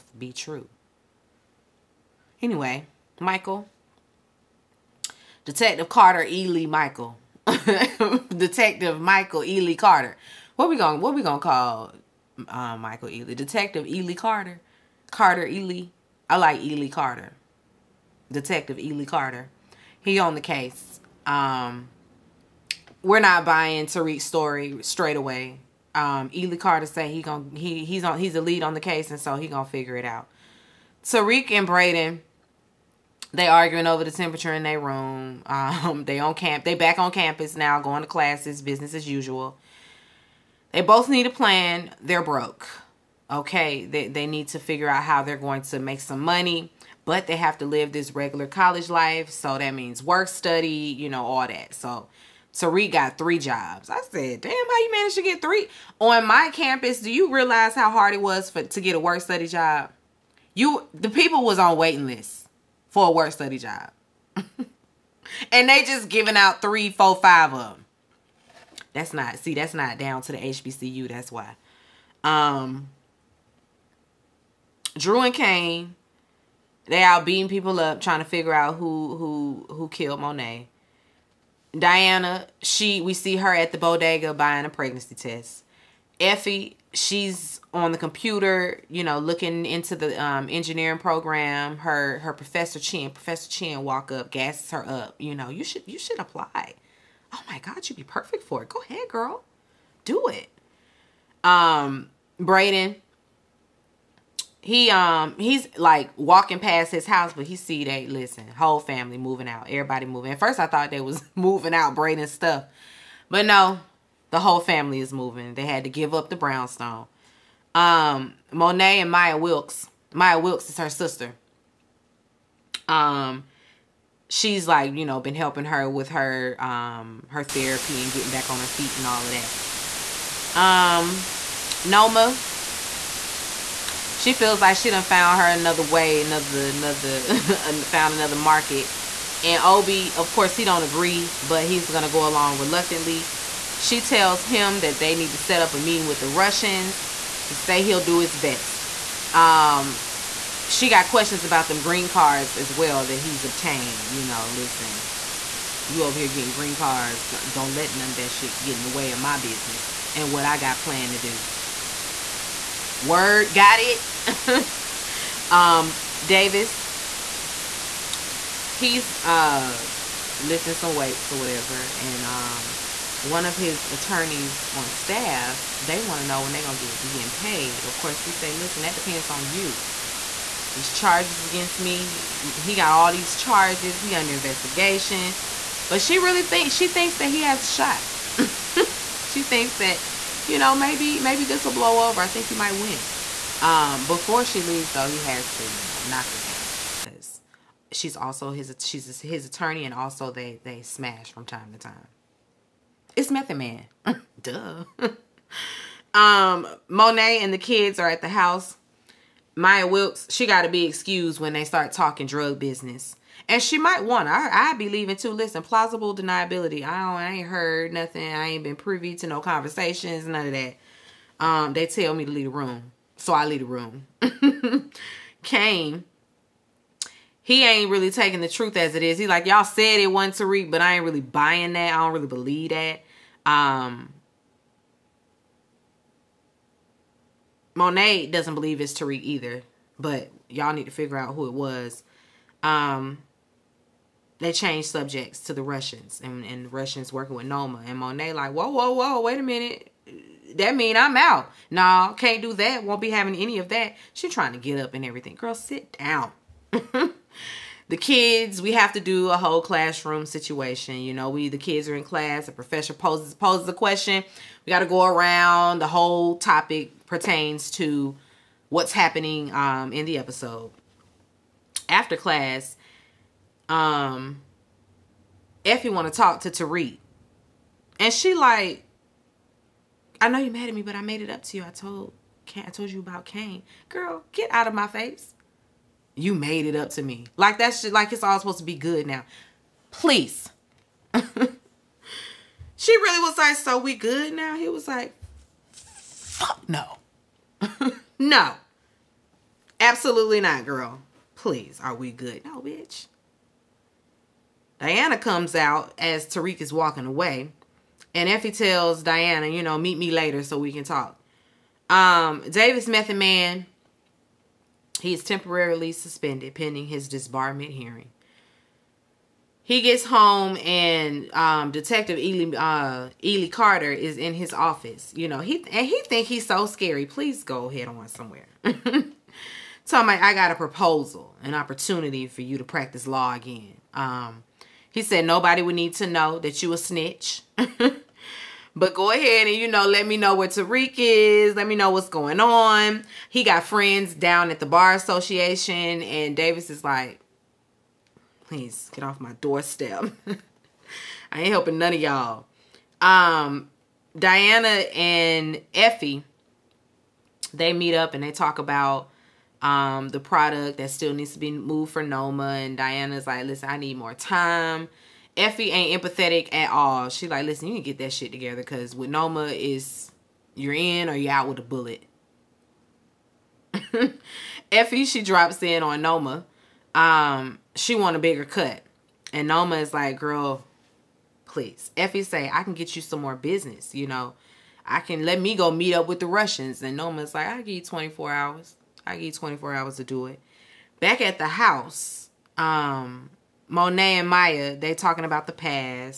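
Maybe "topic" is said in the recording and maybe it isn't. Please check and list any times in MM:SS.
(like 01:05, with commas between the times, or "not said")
04:26.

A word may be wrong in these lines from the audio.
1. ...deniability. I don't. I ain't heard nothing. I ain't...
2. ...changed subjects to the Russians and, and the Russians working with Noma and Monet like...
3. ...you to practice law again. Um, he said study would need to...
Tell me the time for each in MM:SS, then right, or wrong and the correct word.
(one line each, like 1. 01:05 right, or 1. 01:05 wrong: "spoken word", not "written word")
1. 03:36 right
2. 04:04 right
3. 05:32 wrong: "nobody", not "study".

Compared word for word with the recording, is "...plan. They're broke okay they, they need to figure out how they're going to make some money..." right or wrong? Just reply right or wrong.
right.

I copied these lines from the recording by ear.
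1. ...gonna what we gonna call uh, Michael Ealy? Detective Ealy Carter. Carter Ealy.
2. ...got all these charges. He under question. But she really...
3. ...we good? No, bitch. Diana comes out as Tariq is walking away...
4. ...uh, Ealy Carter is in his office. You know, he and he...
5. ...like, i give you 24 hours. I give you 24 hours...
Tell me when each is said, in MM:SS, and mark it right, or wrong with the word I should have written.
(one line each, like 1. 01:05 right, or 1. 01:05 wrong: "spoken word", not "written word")
1. 00:10 right
2. 03:02 wrong: "investigation", not "question"
3. 05:01 right
4. 05:22 right
5. 06:27 right.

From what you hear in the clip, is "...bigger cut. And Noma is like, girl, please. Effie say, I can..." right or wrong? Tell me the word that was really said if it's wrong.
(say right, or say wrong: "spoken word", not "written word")
right.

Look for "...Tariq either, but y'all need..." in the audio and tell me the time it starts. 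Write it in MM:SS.
03:58.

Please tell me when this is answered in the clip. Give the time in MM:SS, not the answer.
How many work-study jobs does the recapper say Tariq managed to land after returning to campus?
00:53.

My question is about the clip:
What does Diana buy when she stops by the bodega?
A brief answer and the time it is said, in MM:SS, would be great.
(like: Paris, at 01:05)
Pregnancy test, at 01:24.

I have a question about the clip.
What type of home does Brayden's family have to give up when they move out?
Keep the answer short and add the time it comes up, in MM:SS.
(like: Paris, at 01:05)
Brownstone, at 01:56.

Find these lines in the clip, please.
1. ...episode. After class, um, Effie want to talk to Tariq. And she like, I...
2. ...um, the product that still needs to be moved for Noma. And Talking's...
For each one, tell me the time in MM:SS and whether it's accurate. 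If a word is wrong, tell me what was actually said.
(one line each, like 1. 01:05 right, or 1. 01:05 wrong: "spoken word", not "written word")
1. 04:30 right
2. 05:59 wrong: "Diana", not "Talking".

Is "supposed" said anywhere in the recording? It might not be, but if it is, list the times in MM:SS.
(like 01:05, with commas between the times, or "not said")
04:48.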